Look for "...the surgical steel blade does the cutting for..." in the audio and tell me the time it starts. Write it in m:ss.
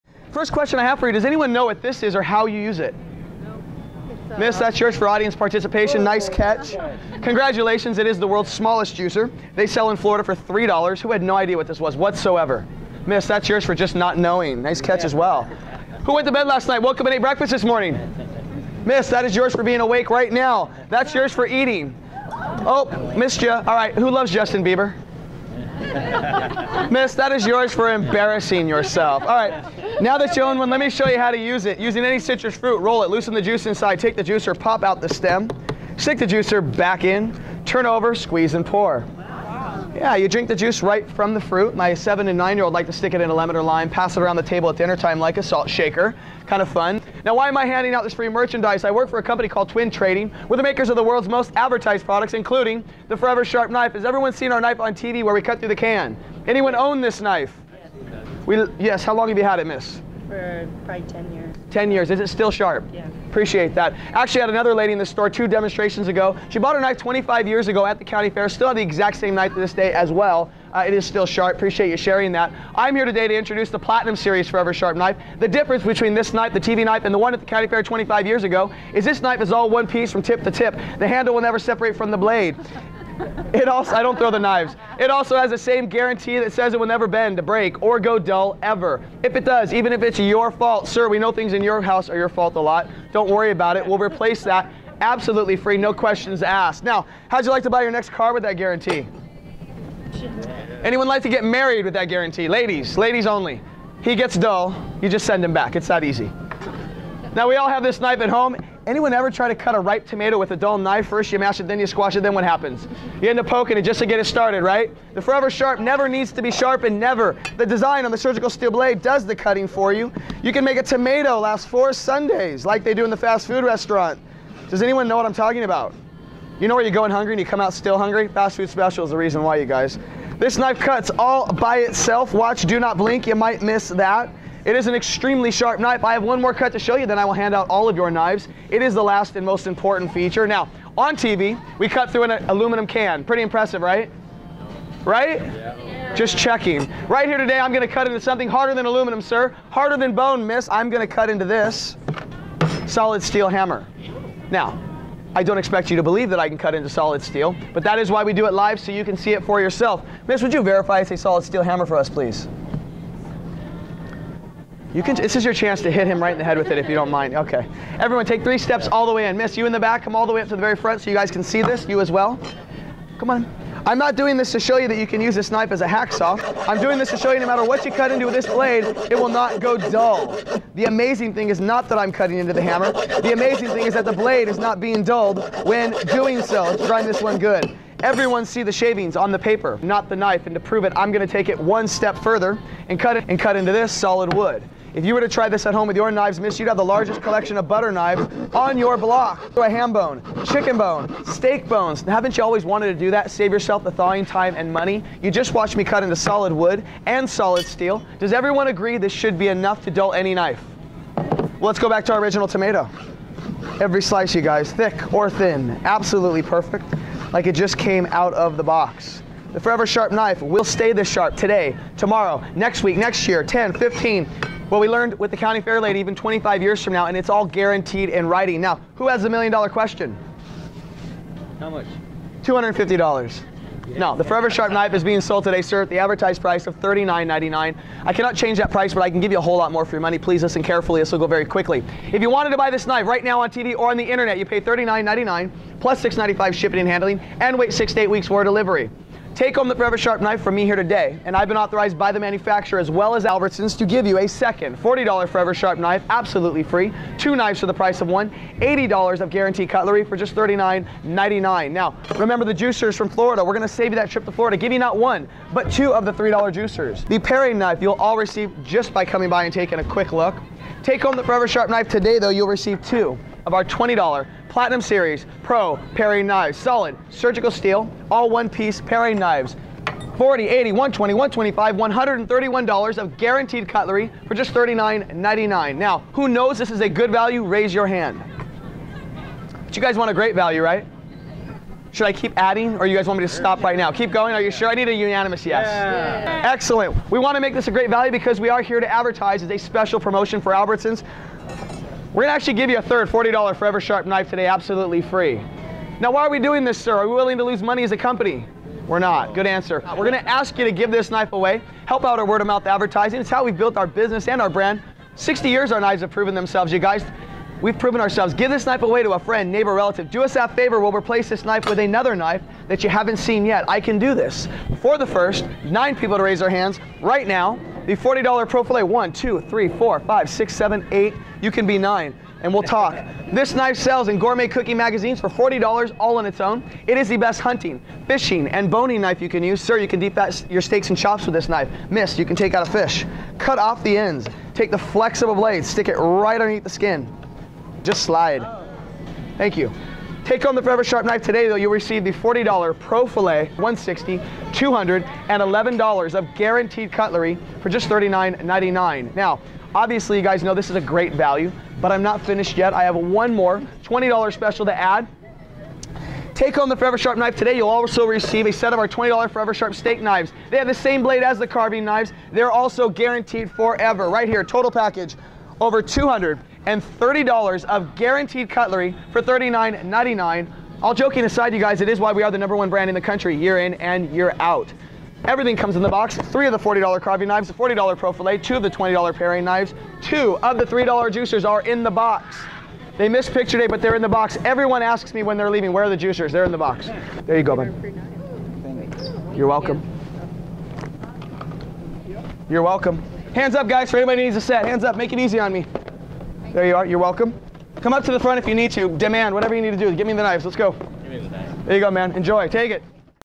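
1:58.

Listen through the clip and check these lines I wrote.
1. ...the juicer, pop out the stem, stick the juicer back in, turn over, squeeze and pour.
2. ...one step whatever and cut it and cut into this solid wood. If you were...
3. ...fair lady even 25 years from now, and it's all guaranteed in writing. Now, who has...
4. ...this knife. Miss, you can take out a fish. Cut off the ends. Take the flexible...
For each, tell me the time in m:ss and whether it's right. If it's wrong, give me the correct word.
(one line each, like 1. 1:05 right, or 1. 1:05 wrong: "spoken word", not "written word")
1. 0:34 right
2. 3:11 wrong: "further", not "whatever"
3. 3:45 right
4. 5:41 right.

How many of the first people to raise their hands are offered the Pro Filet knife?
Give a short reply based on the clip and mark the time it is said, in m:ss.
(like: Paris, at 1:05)
9, at 5:25.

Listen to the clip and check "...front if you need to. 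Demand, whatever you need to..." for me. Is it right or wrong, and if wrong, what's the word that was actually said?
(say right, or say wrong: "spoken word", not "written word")
right.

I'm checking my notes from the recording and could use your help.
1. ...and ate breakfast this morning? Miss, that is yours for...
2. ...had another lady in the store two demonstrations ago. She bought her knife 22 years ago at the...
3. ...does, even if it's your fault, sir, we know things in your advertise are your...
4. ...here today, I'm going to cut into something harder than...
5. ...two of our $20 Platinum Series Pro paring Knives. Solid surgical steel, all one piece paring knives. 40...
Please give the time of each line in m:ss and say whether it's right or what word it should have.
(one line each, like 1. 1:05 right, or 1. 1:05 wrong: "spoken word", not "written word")
1. 0:17 right
2. 1:04 wrong: "25", not "22"
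3. 1:29 wrong: "house", not "advertise"
4. 2:27 right
5. 4:32 right.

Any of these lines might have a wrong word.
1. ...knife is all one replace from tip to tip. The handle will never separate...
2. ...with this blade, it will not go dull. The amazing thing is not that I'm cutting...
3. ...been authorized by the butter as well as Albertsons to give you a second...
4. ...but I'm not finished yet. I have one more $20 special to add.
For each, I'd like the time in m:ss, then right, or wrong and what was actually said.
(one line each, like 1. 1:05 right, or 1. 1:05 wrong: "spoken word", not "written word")
1. 1:19 wrong: "piece", not "replace"
2. 2:58 right
3. 4:11 wrong: "manufacturer", not "butter"
4. 6:01 right.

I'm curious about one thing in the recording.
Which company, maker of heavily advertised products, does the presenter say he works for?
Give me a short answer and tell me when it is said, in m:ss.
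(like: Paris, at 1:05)
Twin Trading, at 0:49.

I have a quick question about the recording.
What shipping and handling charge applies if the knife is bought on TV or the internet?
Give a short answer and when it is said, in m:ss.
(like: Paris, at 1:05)
$6.95, at 4:06.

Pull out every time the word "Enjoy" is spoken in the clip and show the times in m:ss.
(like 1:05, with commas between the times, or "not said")
6:52.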